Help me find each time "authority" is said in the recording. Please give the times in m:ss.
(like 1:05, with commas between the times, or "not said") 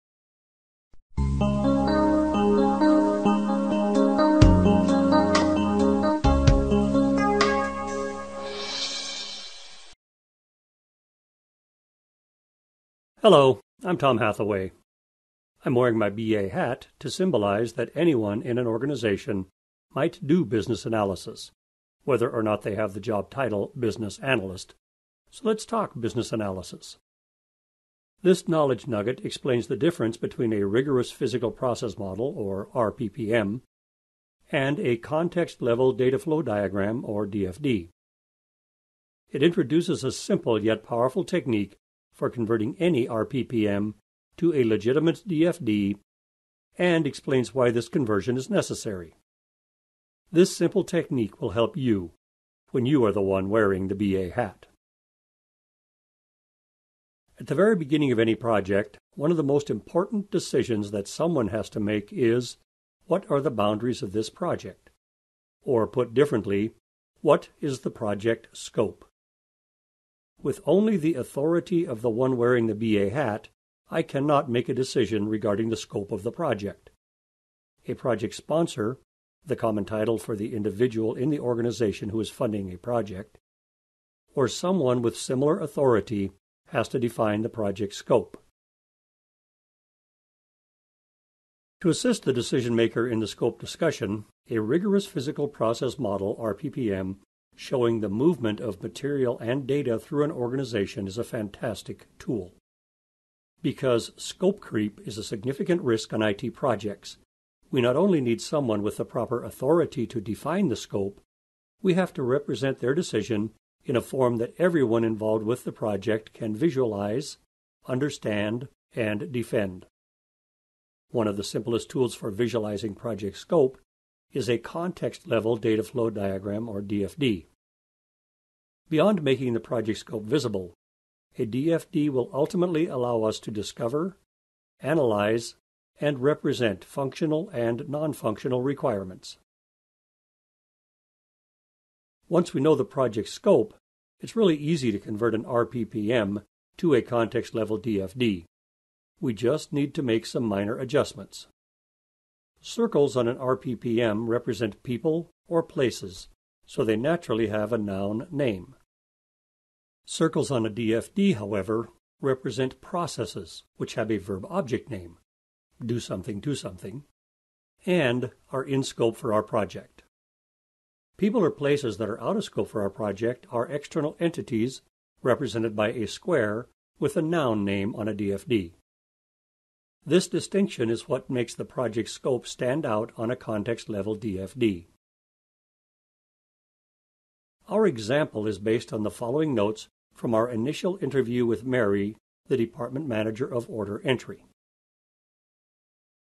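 1:11, 1:25, 1:49.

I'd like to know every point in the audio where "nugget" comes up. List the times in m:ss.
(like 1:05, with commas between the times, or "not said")
0:28.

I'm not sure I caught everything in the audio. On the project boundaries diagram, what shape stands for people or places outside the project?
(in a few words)
a square.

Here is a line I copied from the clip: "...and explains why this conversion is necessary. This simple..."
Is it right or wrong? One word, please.
right.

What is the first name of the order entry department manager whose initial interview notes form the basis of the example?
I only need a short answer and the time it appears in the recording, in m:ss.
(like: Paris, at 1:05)
Mary, at 3:11.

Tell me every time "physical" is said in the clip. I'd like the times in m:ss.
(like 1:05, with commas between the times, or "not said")
0:31, 1:35.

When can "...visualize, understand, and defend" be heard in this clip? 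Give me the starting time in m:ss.
1:56.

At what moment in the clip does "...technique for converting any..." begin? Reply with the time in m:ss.
0:41.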